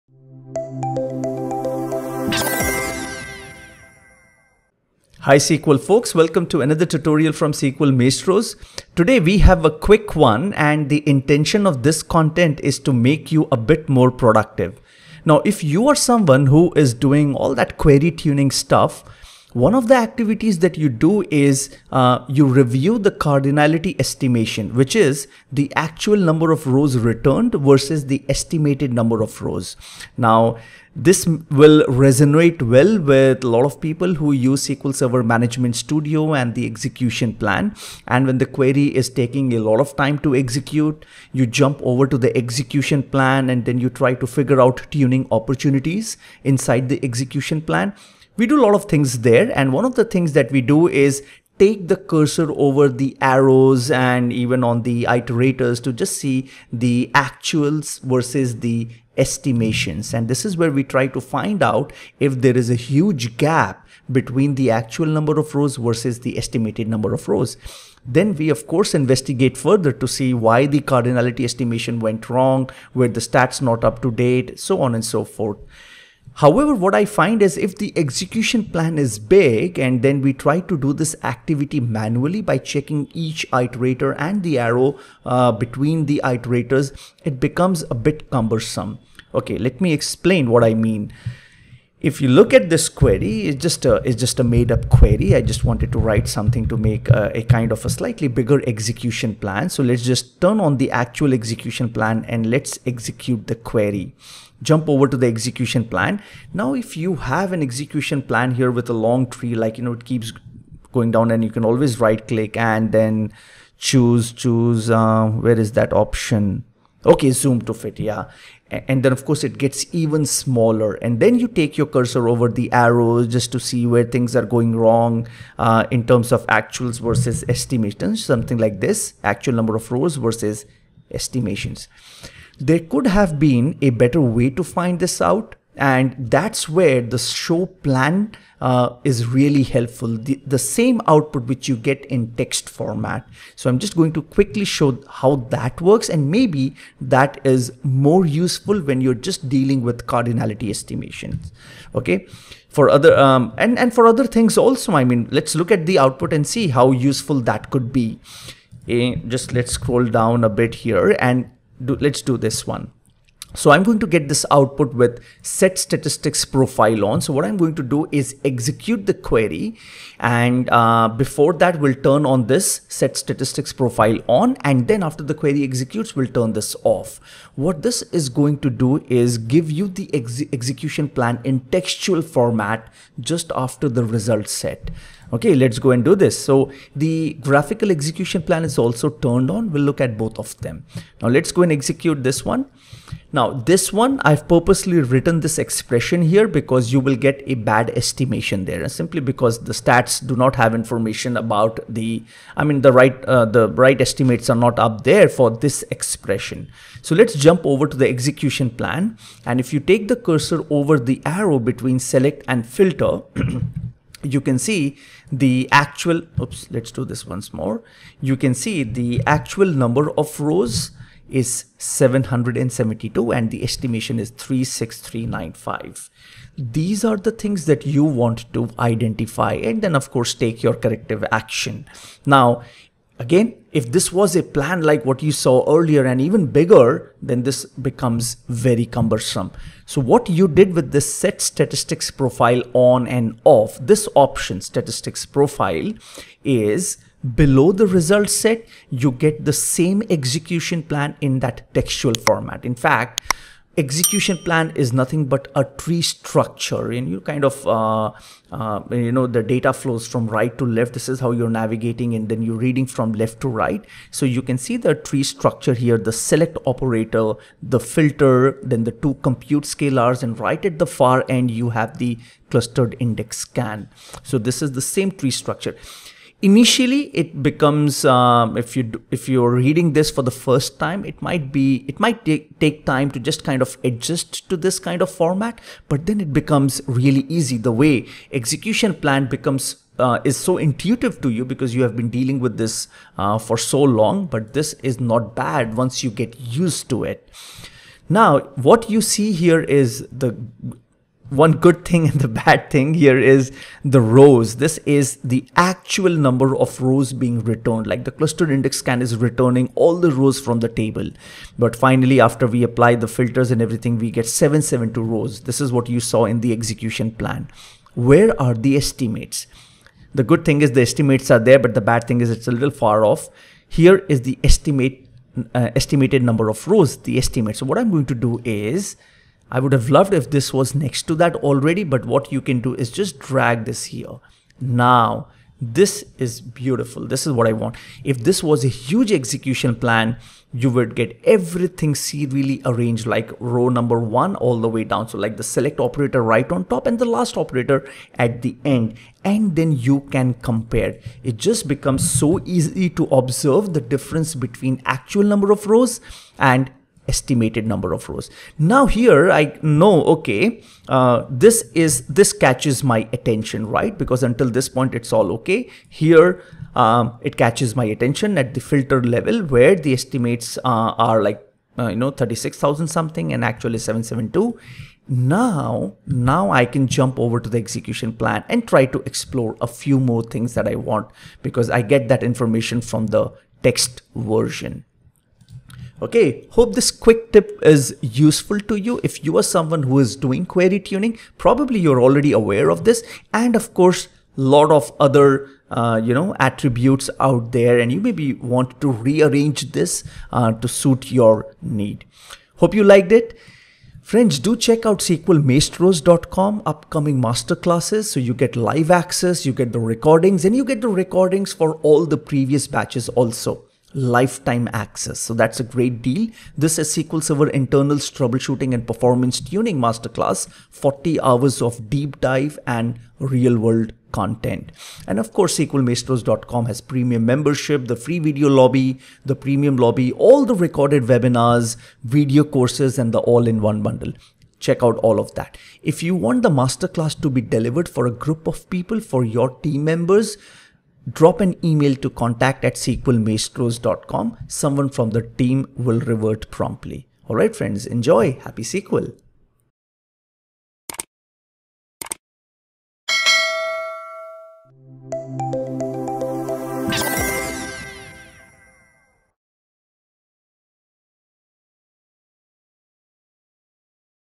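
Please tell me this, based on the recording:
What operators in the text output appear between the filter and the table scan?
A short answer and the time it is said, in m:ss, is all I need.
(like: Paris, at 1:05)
two compute scalars, at 4:28.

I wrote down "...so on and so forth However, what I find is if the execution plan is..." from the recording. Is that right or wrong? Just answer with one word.
right.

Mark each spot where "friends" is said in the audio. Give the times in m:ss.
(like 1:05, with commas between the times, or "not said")
6:44, 7:27.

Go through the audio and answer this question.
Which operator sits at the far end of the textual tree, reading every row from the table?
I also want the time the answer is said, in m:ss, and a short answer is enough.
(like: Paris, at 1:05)
clustered index scan, at 4:32.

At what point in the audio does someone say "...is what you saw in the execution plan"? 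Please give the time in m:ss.
5:15.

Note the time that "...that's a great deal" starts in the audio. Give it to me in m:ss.
6:55.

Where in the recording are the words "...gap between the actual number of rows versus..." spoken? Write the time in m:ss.
1:03.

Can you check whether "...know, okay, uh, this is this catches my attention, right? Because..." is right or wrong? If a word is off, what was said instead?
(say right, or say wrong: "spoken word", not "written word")
right.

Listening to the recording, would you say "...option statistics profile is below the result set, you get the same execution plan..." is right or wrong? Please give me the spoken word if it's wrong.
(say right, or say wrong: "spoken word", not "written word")
right.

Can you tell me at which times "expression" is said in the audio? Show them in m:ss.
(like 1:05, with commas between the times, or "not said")
3:15, 3:25.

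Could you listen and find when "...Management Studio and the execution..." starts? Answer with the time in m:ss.
0:35.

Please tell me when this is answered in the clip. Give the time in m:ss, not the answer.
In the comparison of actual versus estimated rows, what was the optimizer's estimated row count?
3:44.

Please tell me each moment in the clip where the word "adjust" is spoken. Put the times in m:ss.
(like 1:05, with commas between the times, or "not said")
4:43.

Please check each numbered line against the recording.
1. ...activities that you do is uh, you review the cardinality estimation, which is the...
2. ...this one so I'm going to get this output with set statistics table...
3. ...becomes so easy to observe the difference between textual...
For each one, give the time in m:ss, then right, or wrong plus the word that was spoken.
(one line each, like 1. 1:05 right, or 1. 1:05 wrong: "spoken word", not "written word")
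1. 0:19 right
2. 2:42 wrong: "profile", not "table"
3. 5:51 wrong: "actual", not "textual".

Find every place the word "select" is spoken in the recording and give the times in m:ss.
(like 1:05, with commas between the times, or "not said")
3:31, 4:26, 5:45.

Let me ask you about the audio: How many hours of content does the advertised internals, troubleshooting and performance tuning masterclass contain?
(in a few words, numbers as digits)
40.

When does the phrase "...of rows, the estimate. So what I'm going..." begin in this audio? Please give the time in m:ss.
5:26.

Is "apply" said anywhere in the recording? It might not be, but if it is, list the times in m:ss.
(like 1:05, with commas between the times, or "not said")
5:12.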